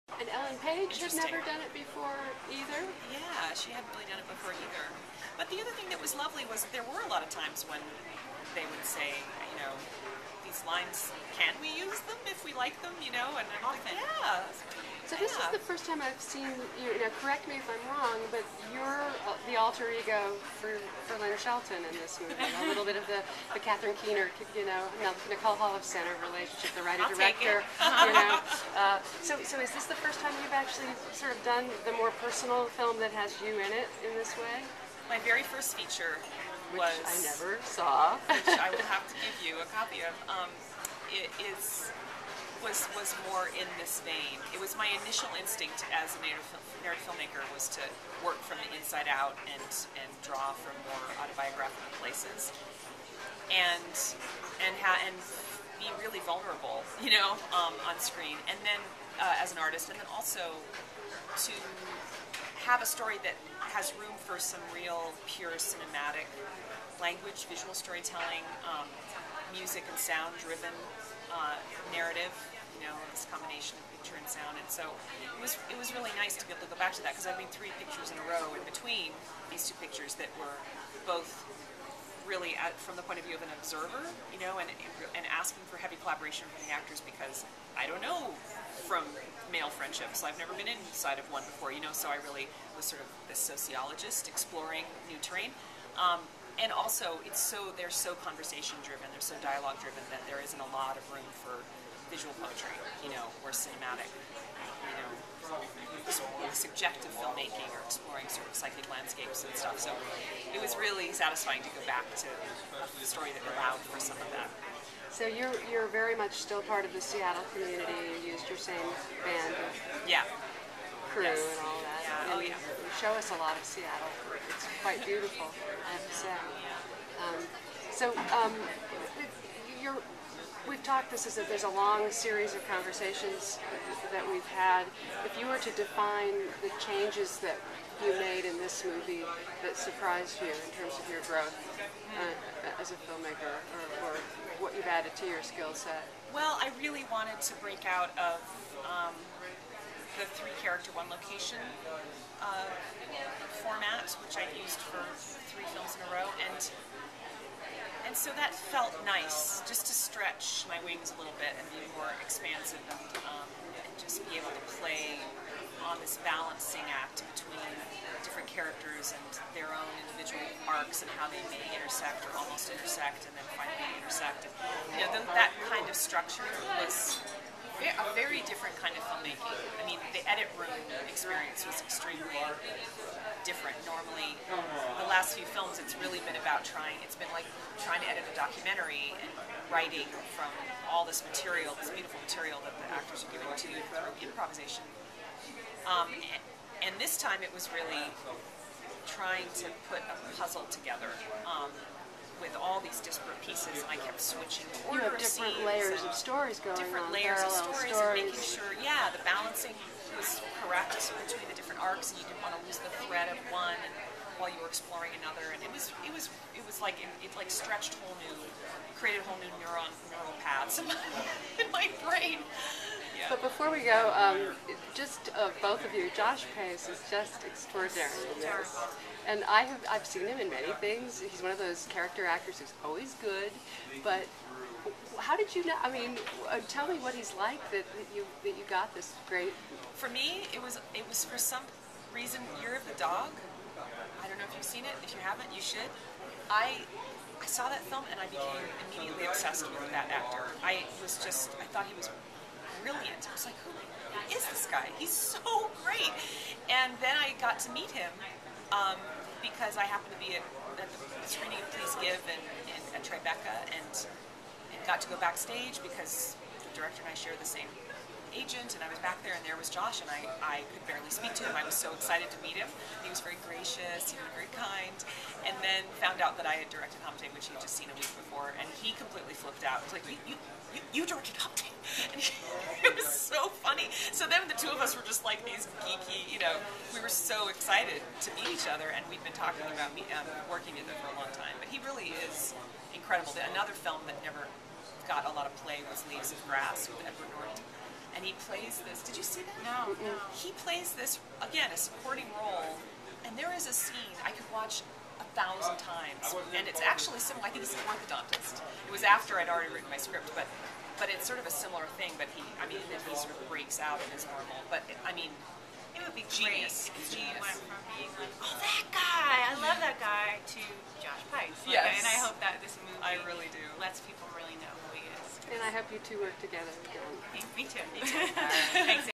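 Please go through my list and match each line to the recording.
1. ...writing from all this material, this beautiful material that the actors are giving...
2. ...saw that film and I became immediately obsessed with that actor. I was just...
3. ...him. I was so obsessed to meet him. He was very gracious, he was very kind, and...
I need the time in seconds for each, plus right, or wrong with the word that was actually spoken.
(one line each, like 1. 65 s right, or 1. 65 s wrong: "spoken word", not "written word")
1. 189 s right
2. 247 s right
3. 271 s wrong: "excited", not "obsessed".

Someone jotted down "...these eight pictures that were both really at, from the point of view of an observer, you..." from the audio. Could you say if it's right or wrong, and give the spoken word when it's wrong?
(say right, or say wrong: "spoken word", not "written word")
wrong: "two", not "eight".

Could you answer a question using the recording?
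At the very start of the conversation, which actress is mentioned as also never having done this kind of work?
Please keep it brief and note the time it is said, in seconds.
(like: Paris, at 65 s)
Ellen Page, at 0 s.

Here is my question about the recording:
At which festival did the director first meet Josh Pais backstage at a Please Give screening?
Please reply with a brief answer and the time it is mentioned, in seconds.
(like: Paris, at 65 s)
Tribeca, at 263 s.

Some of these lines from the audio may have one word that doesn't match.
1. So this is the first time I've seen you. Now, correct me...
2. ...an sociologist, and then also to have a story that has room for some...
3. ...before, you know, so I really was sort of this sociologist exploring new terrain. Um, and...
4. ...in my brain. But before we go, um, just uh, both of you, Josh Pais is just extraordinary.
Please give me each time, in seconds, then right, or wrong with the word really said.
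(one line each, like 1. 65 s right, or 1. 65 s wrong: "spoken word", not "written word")
1. 15 s right
2. 59 s wrong: "artist", not "sociologist"
3. 91 s right
4. 221 s right.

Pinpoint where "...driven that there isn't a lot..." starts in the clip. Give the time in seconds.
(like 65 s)
99 s.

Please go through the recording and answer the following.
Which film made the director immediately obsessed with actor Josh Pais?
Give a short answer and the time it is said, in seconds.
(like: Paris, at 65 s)
Year of the Dog, at 242 s.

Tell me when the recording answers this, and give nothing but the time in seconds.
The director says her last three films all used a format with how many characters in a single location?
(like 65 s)
150 s.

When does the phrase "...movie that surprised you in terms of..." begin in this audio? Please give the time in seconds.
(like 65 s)
138 s.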